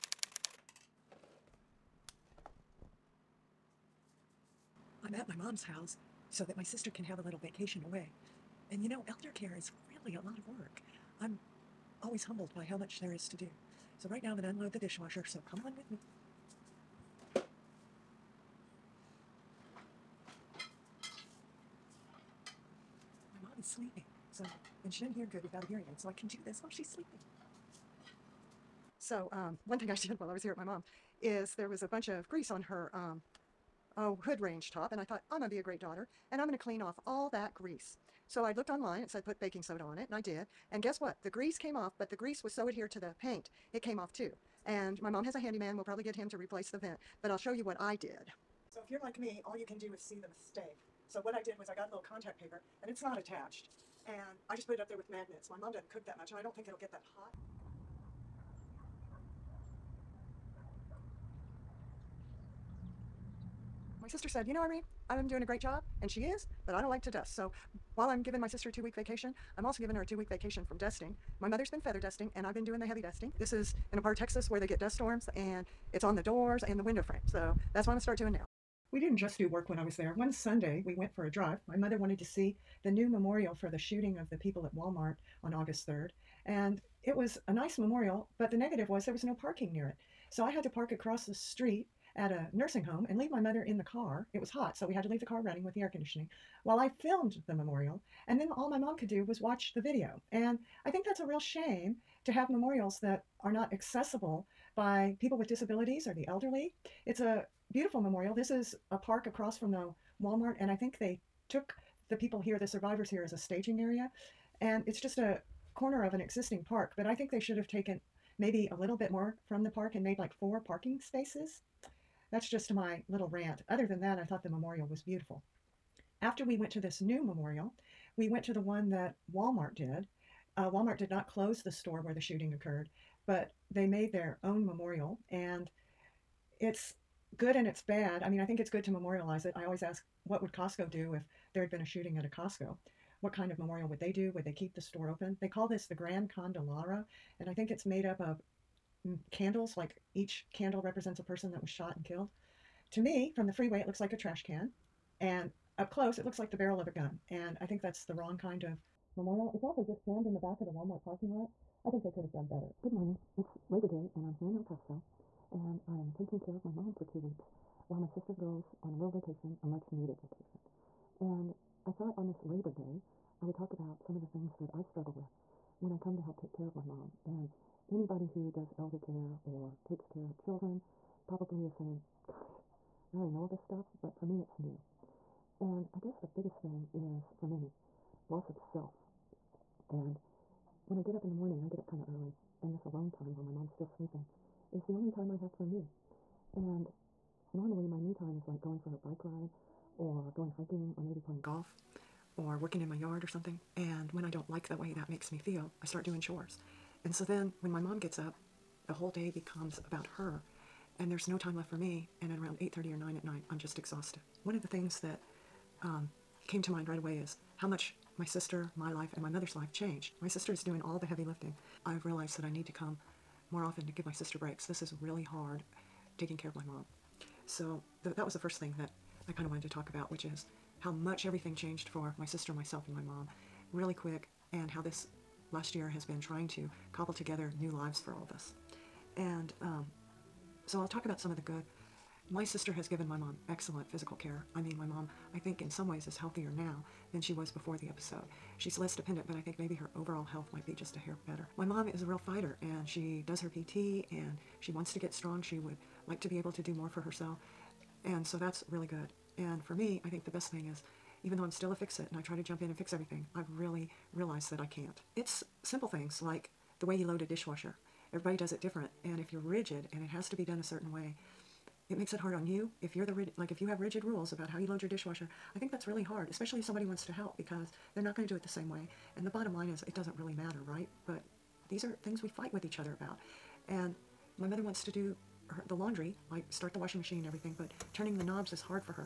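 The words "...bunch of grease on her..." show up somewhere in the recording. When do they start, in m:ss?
0:31.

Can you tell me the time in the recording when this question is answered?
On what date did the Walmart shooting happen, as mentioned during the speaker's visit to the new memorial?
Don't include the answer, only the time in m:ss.
1:25.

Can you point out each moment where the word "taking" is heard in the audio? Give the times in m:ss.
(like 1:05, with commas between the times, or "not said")
2:46, 3:46.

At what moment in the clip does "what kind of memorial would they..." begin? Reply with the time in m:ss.
2:23.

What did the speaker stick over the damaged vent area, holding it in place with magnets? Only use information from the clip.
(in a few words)
contact paper.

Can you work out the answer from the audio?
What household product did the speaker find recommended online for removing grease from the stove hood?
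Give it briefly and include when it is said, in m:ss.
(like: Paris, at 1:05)
baking soda, at 0:39.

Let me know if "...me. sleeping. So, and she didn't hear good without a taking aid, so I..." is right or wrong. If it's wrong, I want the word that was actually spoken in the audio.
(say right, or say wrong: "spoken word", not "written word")
wrong: "hearing", not "taking".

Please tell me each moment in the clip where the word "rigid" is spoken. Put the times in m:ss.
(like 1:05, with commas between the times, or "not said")
4:29, 4:33.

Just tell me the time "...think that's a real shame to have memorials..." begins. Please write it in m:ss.
1:40.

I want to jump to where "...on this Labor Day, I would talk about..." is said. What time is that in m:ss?
2:52.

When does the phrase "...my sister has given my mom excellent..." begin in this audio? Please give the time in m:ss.
4:02.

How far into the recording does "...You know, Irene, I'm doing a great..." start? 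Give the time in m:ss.
1:04.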